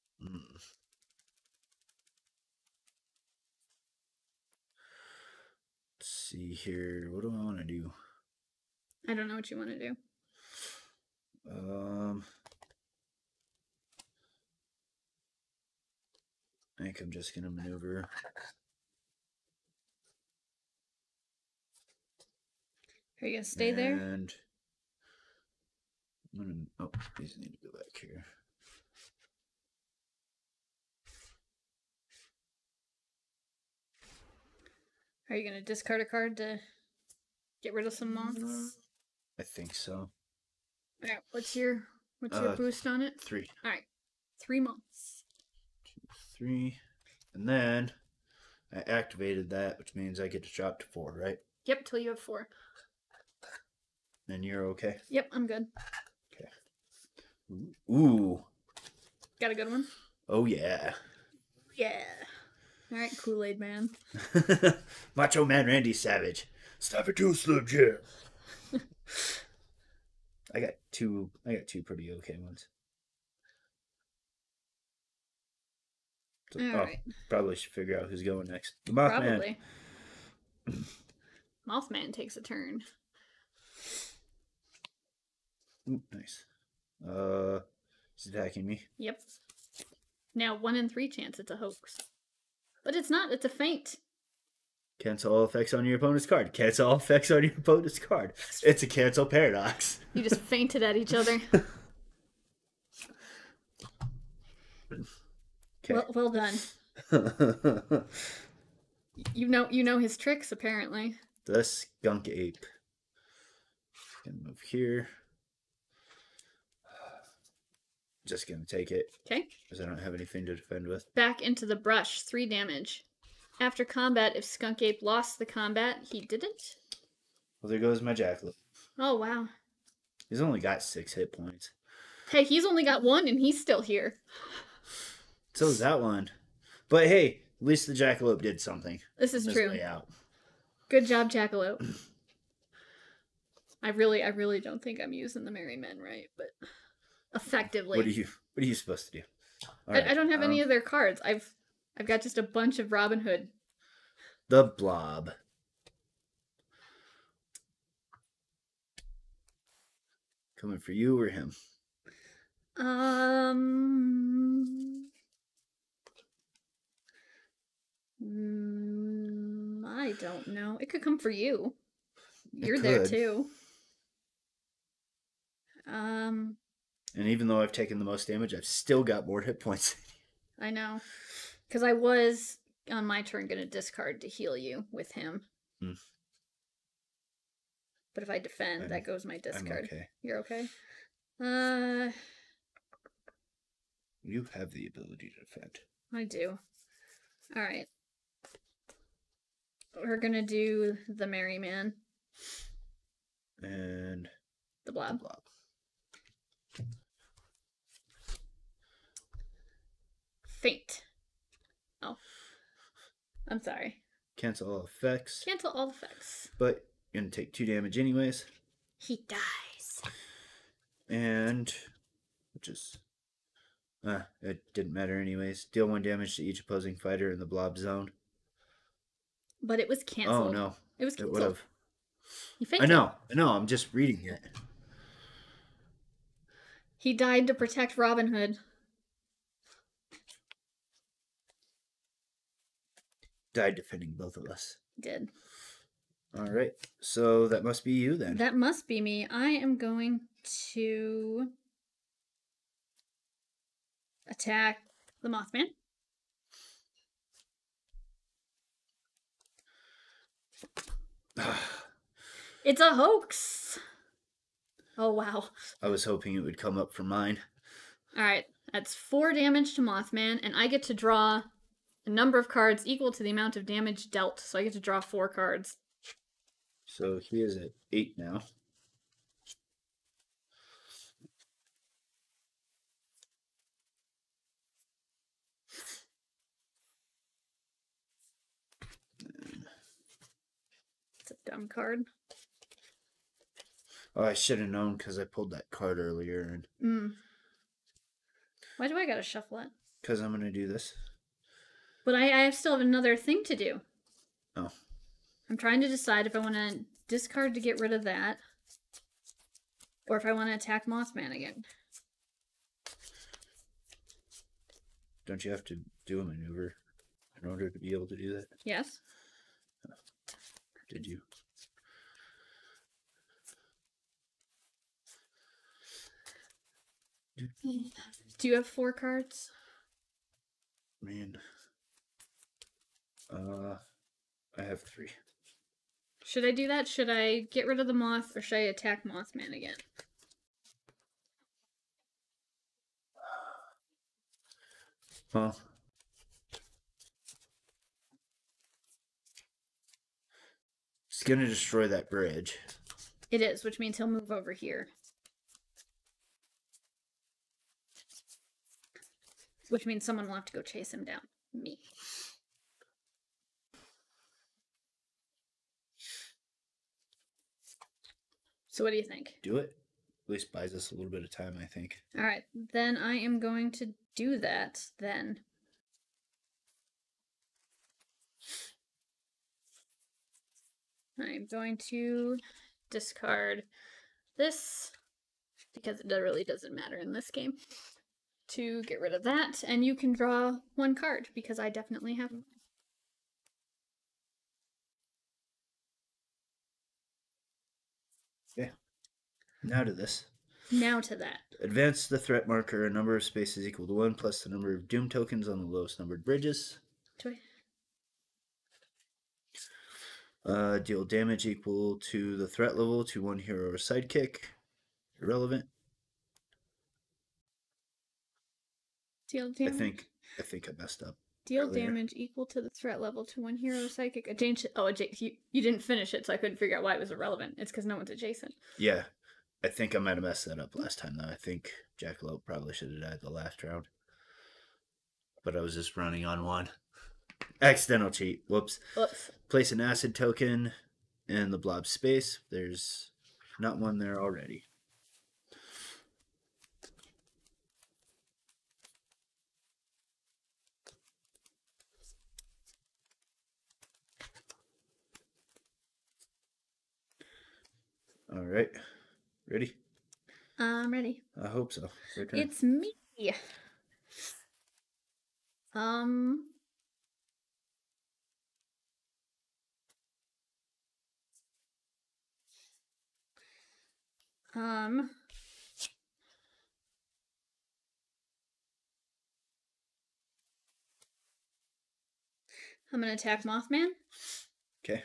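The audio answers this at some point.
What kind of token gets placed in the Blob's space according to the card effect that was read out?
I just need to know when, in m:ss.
7:19.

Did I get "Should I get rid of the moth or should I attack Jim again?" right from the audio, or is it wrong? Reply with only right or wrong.
wrong.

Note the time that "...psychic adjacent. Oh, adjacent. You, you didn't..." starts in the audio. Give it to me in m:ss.
7:03.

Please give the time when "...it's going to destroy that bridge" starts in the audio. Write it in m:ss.
5:51.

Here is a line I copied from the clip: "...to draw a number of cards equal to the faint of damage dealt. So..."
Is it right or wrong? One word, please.
wrong.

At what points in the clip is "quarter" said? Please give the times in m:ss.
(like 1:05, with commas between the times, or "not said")
not said.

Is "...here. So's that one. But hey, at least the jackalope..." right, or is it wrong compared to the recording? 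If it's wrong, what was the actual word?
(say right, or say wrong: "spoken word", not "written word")
right.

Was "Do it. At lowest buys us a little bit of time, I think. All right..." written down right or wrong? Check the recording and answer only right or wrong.
wrong.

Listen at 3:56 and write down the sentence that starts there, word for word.
He died to protect Robin Hood.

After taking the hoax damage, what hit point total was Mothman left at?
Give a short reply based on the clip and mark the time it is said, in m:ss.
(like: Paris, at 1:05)
8, at 4:37.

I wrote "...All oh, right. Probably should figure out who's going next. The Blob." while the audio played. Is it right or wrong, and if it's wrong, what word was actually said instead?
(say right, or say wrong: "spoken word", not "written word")
wrong: "Mothman", not "Blob".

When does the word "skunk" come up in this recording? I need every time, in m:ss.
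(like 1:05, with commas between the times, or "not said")
1:51, 2:04.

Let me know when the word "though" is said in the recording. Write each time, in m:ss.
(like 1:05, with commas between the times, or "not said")
2:57, 7:11.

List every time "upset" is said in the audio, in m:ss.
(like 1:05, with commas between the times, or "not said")
not said.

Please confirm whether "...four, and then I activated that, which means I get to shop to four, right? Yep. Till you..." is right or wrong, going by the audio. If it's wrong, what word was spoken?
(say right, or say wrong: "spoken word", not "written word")
wrong: "three", not "four".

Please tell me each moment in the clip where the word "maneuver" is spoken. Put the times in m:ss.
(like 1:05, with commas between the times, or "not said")
0:17, 5:16.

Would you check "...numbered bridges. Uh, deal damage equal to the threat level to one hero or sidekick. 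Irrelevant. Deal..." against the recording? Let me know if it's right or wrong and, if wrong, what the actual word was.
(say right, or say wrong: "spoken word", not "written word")
right.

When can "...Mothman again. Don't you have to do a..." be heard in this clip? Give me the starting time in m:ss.
5:10.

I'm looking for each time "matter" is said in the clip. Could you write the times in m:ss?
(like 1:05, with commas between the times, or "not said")
3:44, 6:26.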